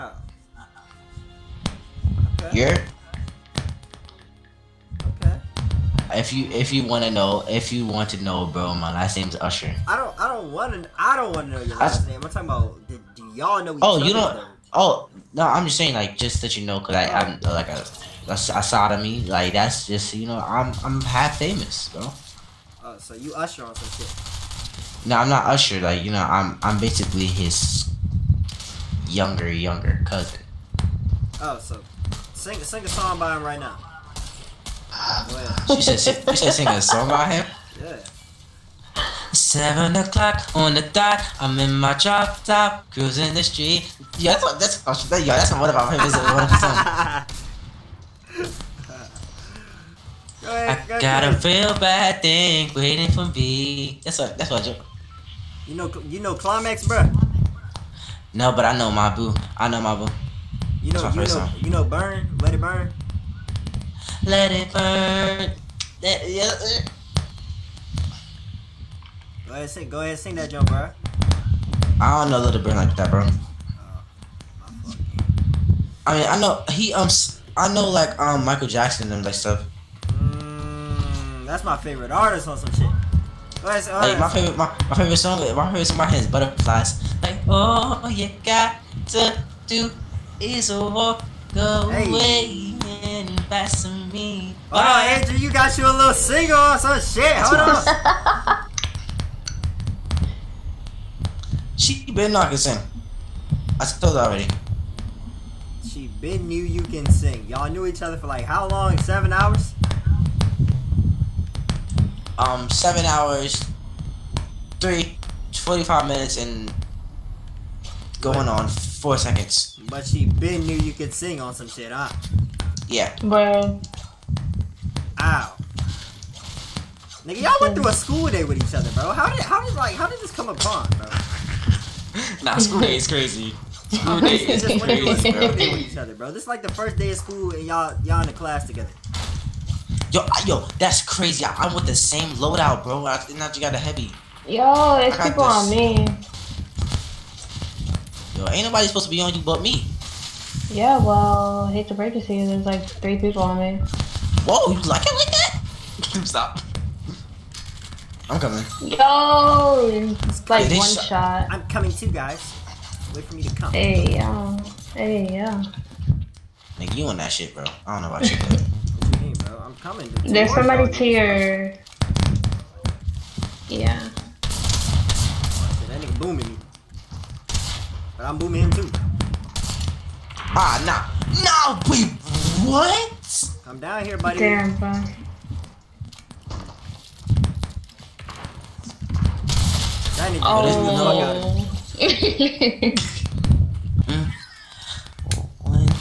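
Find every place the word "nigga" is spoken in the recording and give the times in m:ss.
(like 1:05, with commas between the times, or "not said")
2:07, 2:46, 2:56.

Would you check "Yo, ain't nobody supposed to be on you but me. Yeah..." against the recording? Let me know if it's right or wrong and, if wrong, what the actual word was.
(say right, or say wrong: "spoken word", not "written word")
right.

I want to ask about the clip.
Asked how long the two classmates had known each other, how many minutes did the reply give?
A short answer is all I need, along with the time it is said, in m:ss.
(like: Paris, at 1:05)
45, at 1:55.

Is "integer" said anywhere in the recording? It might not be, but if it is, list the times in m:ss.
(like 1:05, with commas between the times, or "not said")
not said.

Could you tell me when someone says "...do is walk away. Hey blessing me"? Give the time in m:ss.
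1:29.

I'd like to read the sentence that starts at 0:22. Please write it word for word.
Oh, so you Usher on some shit?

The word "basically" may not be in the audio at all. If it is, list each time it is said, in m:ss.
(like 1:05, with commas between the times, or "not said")
0:26.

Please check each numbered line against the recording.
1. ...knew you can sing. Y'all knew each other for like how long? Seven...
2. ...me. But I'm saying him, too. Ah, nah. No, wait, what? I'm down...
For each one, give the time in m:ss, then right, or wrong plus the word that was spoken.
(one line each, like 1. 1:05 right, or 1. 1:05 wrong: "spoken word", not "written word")
1. 1:46 right
2. 2:56 wrong: "booming", not "saying".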